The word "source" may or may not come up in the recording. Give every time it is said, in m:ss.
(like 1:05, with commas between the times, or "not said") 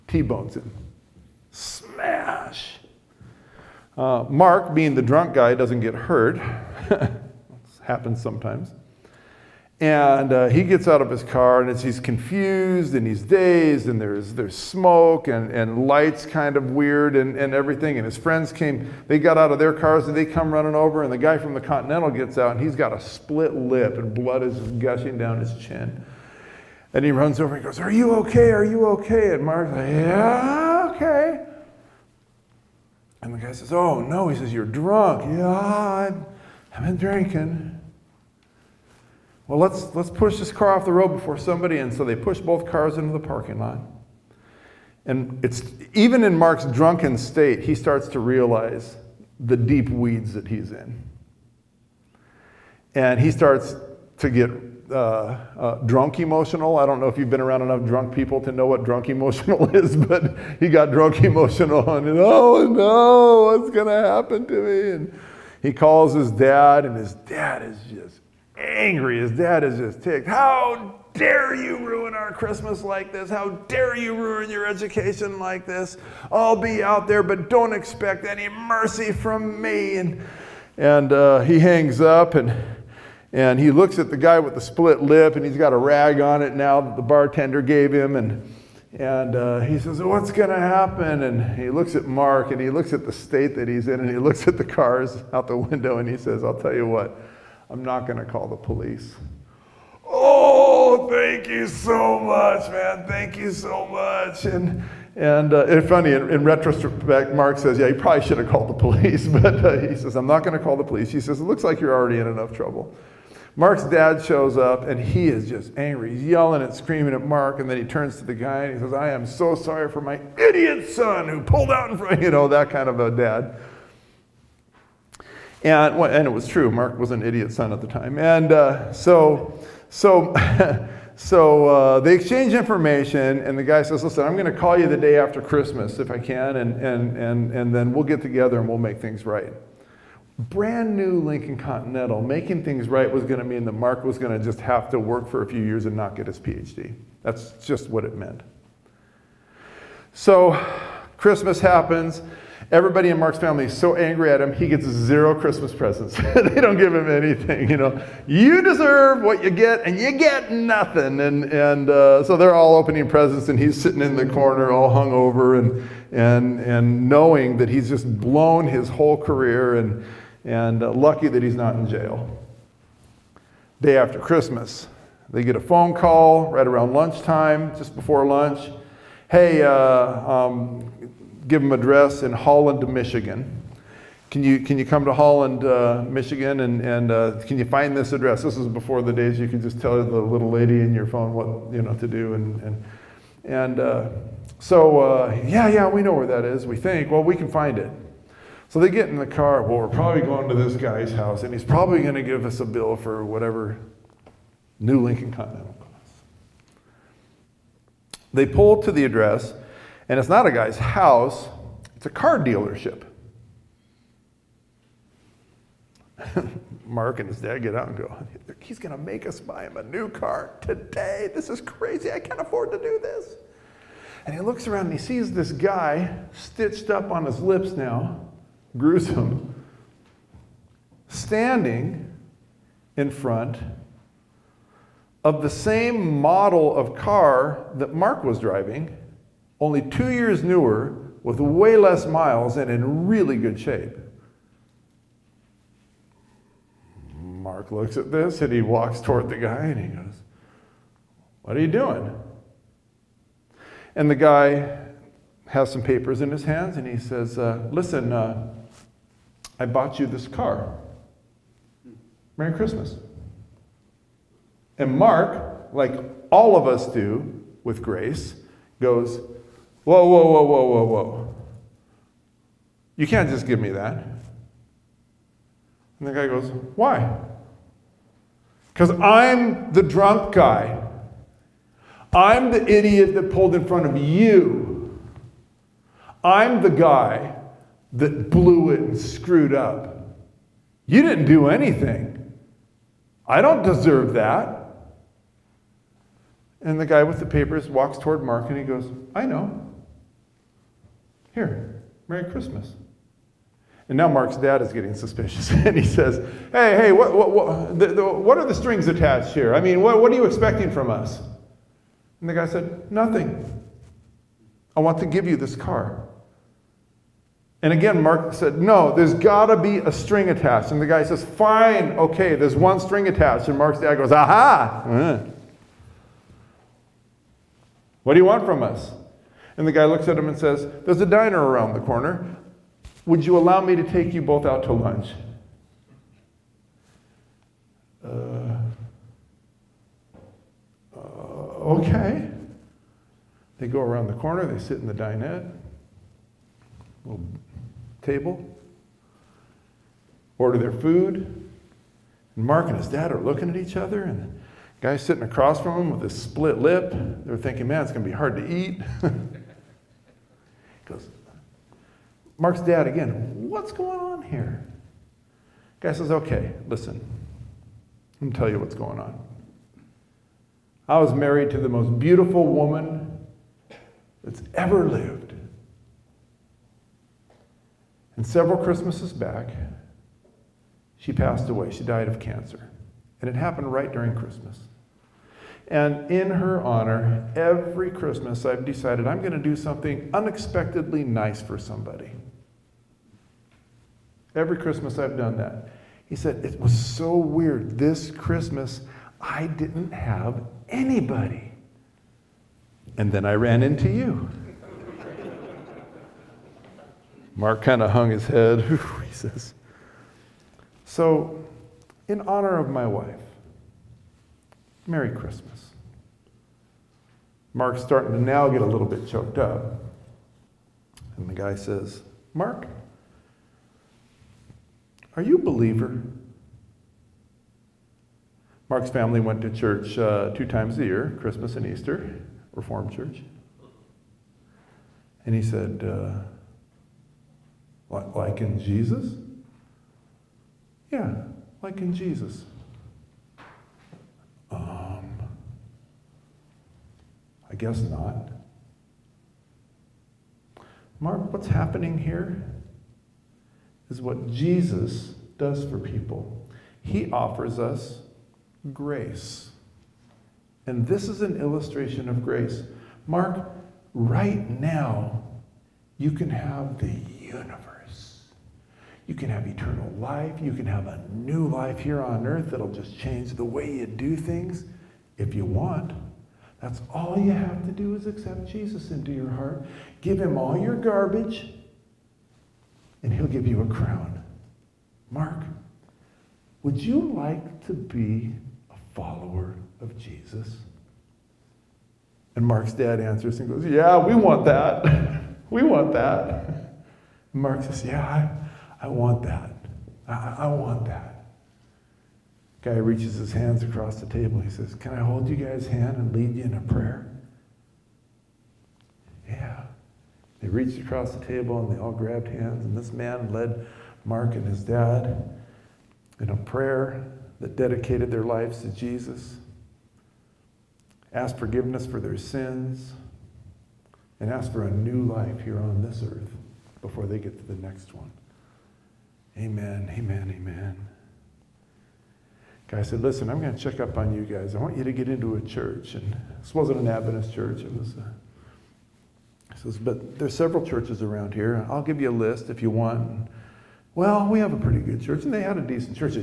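not said.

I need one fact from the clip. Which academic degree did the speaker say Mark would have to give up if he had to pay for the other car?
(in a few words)
PhD.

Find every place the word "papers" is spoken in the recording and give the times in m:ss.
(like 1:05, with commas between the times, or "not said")
4:15, 4:57.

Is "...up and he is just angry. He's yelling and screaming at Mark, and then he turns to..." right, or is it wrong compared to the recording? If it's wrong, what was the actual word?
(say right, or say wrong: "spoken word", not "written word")
right.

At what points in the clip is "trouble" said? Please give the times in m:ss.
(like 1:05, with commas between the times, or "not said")
1:52.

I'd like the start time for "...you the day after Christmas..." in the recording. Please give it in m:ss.
2:14.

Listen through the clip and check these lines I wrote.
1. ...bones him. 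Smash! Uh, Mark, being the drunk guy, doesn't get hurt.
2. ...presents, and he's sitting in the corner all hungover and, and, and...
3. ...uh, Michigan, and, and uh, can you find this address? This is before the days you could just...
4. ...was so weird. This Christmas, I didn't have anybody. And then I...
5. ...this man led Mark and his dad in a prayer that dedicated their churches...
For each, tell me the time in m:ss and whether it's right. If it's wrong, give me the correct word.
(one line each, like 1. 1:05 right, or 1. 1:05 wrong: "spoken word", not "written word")
1. 0:00 right
2. 2:43 right
3. 3:05 right
4. 6:36 right
5. 8:32 wrong: "lives", not "churches".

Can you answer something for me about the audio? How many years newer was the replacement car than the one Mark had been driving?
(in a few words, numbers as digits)
2.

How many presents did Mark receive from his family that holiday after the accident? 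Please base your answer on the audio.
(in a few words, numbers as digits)
0.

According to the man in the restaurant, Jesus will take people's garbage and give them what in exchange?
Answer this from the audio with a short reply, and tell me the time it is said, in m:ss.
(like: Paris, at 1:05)
A crown, at 8:03.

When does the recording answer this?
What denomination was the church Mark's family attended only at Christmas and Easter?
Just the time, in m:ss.
7:12.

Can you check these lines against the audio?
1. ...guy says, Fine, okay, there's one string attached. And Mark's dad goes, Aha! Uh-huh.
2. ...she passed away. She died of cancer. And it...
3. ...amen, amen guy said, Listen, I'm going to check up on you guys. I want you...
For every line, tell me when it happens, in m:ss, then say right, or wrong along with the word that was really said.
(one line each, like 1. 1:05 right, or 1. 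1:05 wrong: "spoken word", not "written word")
1. 5:20 right
2. 6:20 right
3. 8:49 right.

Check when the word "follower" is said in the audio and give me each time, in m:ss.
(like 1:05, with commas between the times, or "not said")
8:08.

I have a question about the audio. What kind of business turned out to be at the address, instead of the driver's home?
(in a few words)
A car dealership.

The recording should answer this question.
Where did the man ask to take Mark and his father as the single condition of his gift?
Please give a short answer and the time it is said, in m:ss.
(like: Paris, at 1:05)
A diner, at 5:31.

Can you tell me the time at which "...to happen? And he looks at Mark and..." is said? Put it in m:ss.
1:30.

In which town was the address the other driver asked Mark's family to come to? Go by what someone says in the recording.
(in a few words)
Holland, Michigan.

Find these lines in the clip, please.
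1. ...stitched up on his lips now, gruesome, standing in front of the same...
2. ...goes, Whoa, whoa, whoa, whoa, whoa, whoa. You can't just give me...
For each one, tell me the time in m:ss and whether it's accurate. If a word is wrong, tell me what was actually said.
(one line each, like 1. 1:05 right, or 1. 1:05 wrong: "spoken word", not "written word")
1. 3:46 right
2. 4:28 right.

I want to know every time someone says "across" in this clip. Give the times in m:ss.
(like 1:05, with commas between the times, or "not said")
5:55, 8:23, 8:30.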